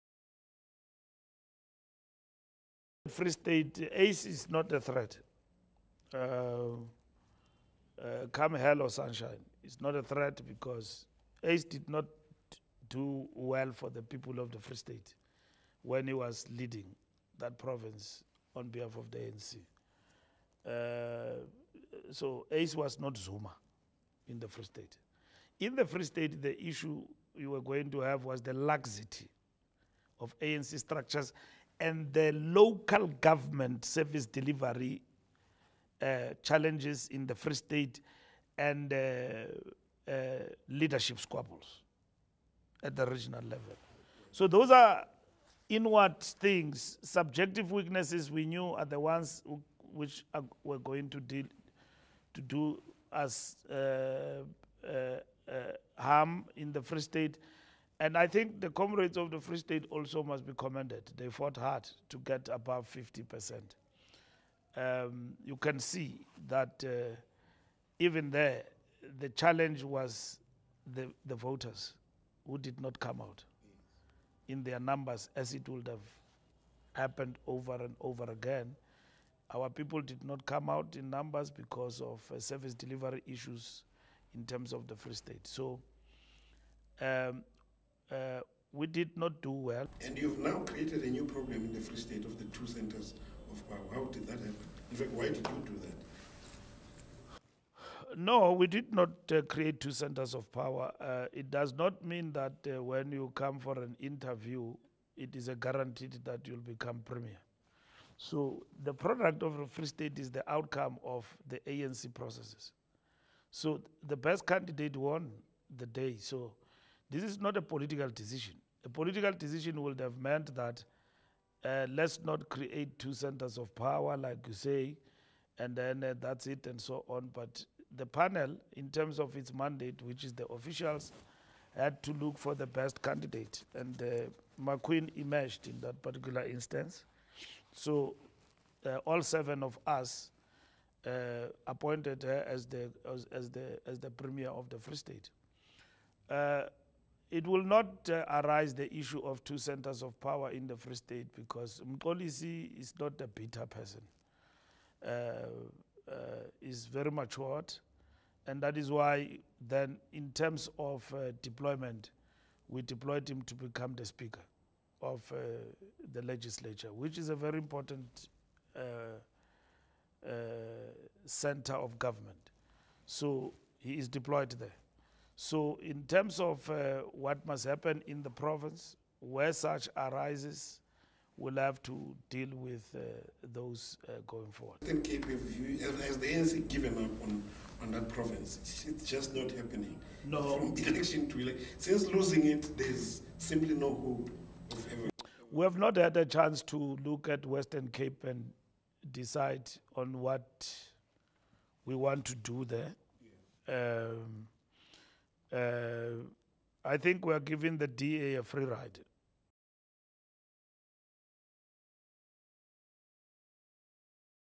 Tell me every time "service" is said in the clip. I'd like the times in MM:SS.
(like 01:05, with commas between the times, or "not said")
00:33, 01:22.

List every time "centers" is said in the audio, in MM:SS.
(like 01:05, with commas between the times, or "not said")
01:32, 01:39, 02:03, 02:29, 02:51.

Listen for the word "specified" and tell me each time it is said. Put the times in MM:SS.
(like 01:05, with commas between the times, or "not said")
not said.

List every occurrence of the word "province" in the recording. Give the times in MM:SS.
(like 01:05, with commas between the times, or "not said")
00:17, 02:58, 03:08.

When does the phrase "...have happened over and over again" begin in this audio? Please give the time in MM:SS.
01:15.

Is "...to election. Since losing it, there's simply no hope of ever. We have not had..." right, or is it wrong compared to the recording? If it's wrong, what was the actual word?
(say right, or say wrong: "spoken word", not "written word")
right.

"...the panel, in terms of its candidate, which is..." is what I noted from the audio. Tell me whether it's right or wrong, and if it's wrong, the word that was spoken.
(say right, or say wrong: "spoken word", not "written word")
wrong: "mandate", not "candidate".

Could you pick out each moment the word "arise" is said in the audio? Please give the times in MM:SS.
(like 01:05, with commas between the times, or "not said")
02:28, 02:59.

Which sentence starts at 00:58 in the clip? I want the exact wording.
And I think the comrades of the Free State also must be commended.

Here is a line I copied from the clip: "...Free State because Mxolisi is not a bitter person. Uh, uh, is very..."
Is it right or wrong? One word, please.
right.